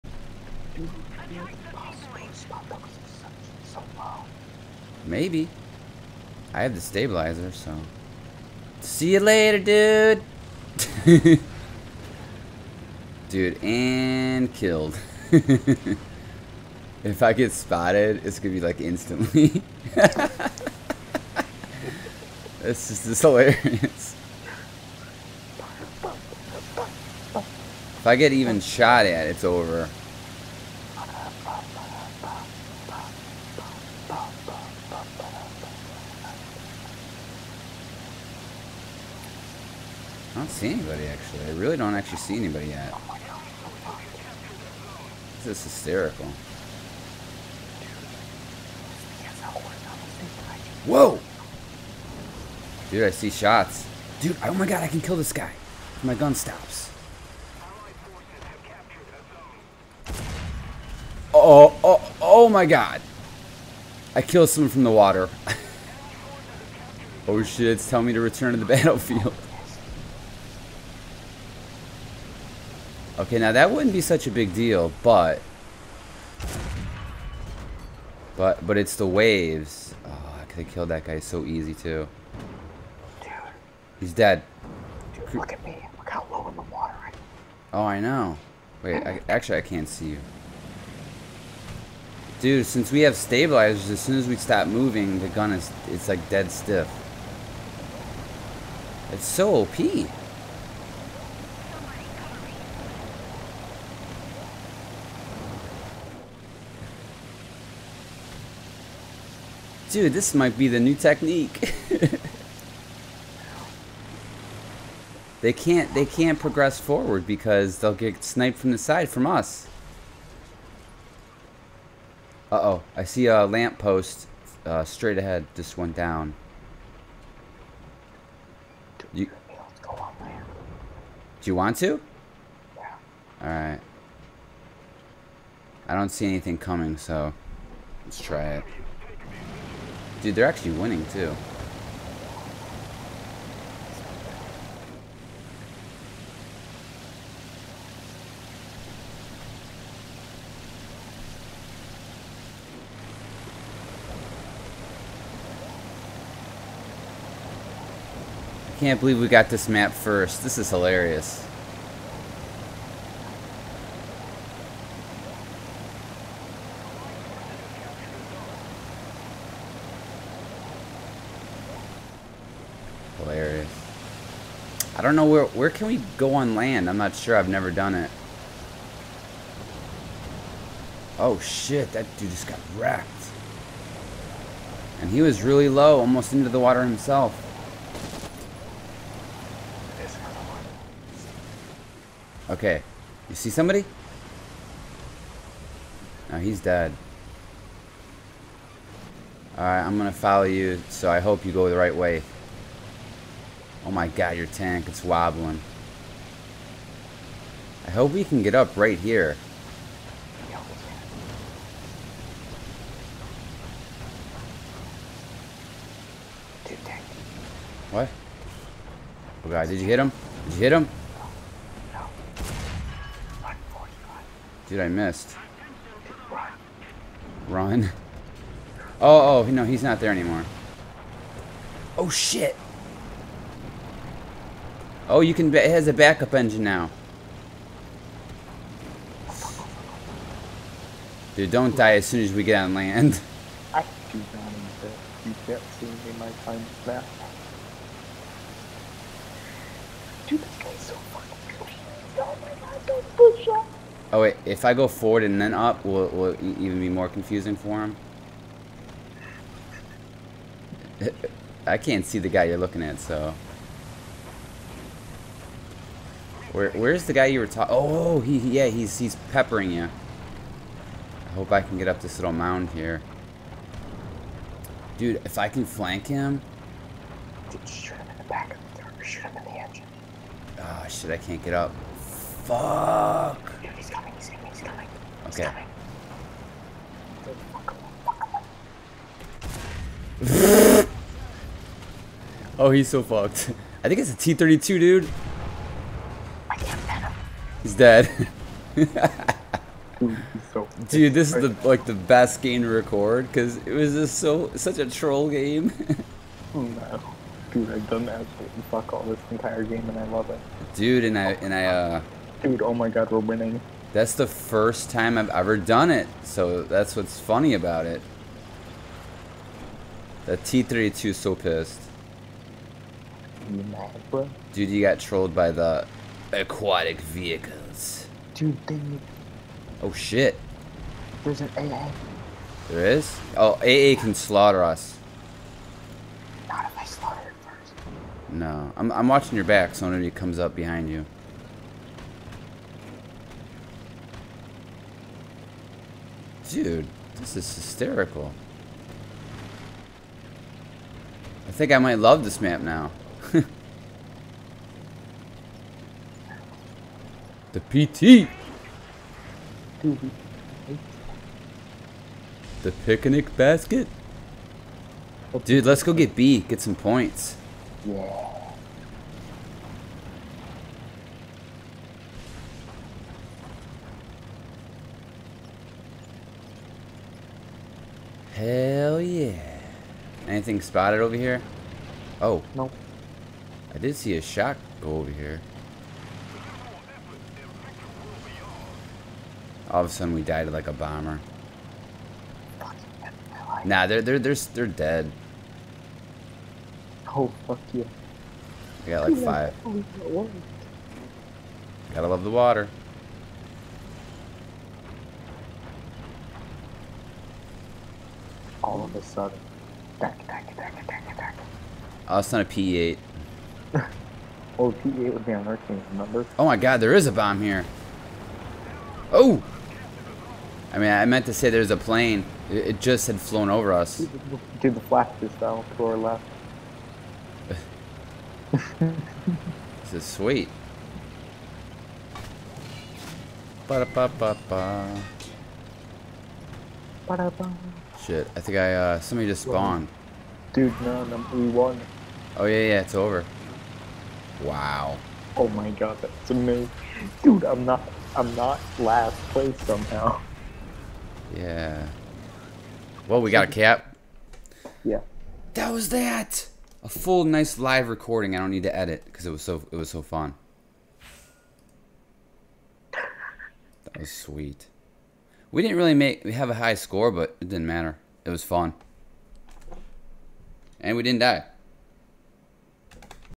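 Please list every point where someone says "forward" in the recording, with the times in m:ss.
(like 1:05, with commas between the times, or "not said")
1:56, 4:14.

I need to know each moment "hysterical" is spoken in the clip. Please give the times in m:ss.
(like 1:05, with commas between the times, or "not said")
0:45, 5:47.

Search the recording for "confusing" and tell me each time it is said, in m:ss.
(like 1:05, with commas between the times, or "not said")
4:17.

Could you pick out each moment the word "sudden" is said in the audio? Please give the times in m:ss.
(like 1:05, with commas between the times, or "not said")
6:29, 6:49.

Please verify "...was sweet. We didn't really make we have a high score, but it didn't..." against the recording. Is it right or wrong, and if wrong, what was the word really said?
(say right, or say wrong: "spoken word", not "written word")
right.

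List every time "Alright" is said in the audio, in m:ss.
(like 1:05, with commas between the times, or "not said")
2:13, 3:19.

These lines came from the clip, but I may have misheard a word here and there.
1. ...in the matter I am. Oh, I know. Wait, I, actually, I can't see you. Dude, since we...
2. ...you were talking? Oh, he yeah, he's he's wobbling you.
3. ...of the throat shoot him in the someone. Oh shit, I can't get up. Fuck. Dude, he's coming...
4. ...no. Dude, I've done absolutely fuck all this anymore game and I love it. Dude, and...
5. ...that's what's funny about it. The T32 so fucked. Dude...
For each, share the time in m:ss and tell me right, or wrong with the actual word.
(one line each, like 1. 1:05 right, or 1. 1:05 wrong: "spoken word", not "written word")
1. 1:26 wrong: "water", not "matter"
2. 4:27 wrong: "peppering", not "wobbling"
3. 4:38 wrong: "engine", not "someone"
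4. 5:06 wrong: "entire", not "anymore"
5. 5:16 wrong: "pissed", not "fucked".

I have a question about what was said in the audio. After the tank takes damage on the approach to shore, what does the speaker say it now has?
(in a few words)
a backup engine.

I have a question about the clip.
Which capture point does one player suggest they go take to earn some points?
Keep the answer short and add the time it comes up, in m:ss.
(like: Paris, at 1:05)
B, at 6:05.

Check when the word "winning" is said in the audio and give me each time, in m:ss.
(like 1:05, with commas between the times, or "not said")
2:20, 5:13.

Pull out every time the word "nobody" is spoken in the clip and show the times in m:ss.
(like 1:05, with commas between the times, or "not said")
5:39.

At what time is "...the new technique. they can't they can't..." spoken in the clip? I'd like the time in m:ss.
1:50.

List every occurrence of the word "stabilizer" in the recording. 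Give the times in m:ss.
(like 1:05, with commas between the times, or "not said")
0:06, 1:33.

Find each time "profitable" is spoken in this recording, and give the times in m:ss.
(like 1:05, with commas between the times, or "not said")
not said.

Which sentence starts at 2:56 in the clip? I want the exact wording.
I'm not sure, I've never done it.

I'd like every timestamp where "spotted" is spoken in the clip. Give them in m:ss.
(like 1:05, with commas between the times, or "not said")
0:17, 6:20.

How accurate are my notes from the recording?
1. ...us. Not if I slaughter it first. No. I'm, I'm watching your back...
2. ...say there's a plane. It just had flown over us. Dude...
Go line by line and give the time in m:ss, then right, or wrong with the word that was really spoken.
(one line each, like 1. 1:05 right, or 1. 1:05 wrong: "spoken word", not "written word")
1. 5:34 right
2. 7:01 right.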